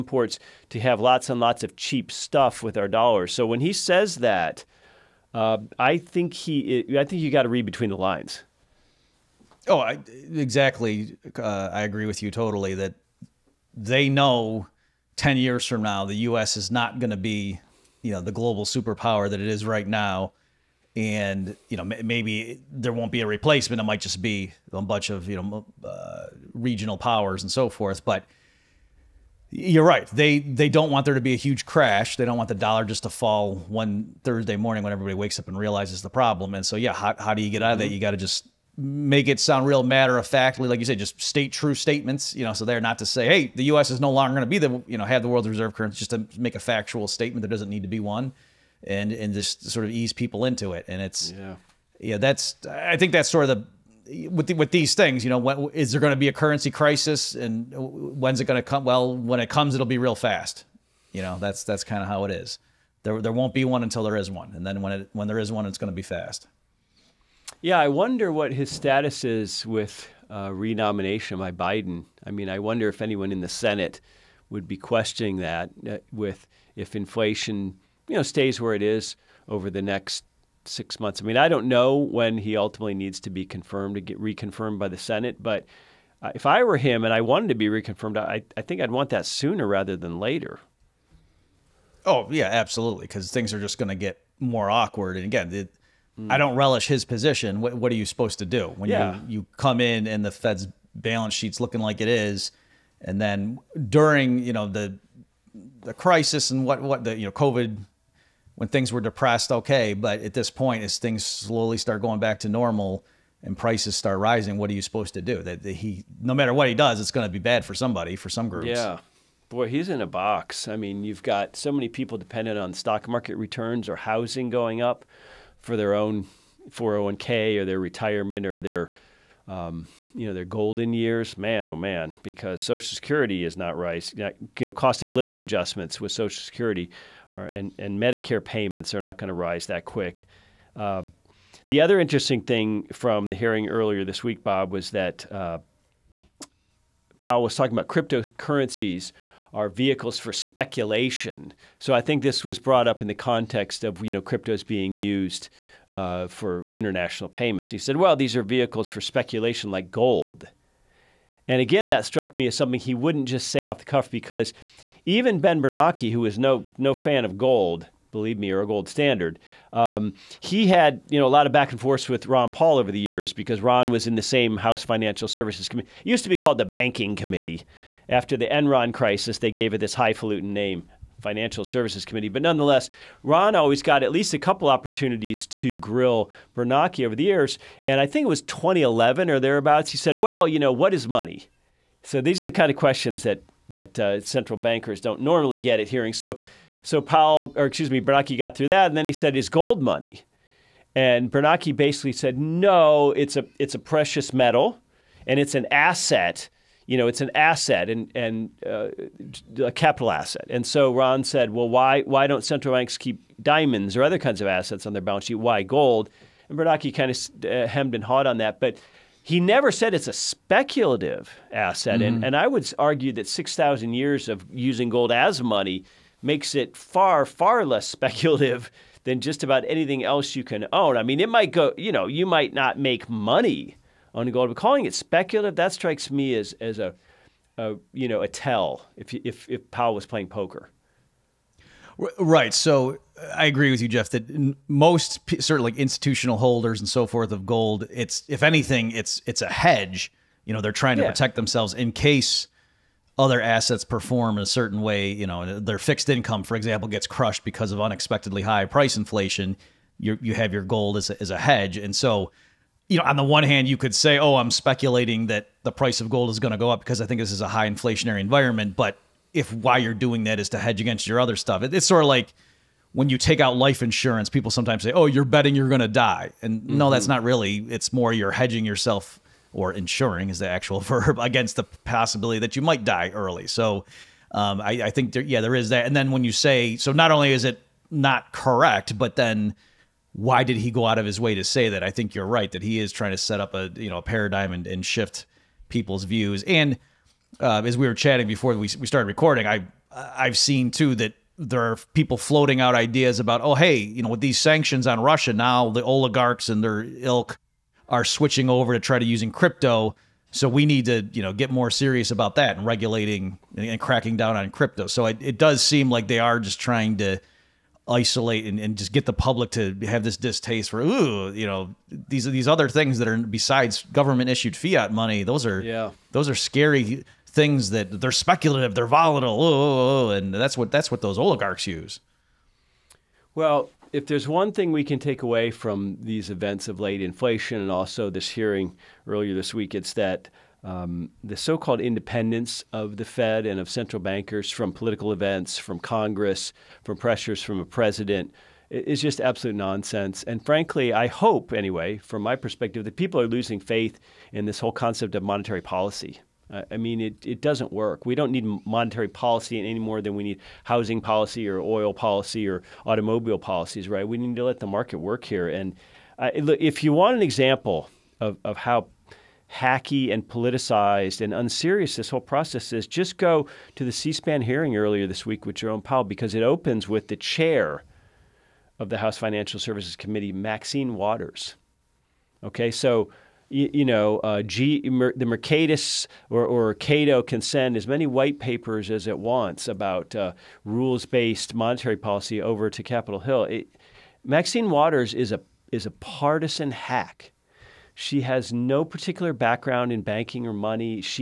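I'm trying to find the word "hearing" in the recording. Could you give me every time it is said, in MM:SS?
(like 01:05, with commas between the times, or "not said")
02:23, 03:15, 05:38, 06:14.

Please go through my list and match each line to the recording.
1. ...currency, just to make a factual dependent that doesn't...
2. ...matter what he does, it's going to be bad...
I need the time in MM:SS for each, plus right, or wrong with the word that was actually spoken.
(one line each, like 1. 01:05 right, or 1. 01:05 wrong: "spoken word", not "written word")
1. 00:45 wrong: "statement", not "dependent"
2. 01:56 right.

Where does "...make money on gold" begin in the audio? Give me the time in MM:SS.
03:52.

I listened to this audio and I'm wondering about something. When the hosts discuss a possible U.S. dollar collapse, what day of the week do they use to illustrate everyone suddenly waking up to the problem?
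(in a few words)
Thursday.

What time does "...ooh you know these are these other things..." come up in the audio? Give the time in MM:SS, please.
05:20.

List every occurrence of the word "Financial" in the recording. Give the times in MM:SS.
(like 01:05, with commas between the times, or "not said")
02:54, 03:01, 06:19.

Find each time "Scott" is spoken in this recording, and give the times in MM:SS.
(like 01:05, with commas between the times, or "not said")
not said.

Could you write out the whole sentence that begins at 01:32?
Oh yeah, absolutely, because things are just going to get more awkward.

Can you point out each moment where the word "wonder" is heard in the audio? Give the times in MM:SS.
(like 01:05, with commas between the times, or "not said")
01:07, 01:12.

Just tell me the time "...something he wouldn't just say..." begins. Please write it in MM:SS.
02:42.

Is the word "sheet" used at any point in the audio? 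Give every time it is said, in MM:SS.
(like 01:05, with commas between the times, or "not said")
01:41, 03:35.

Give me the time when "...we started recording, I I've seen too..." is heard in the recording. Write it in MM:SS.
04:58.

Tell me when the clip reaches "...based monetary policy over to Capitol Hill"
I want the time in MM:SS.
06:31.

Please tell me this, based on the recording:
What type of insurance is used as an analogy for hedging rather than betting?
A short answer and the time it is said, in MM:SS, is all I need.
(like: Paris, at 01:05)
Life insurance, at 04:33.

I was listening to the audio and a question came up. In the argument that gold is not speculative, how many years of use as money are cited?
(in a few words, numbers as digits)
6000.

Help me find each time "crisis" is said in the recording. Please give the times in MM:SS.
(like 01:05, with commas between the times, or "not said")
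00:56, 01:45, 02:58.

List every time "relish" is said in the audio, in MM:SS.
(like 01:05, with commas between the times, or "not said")
01:36.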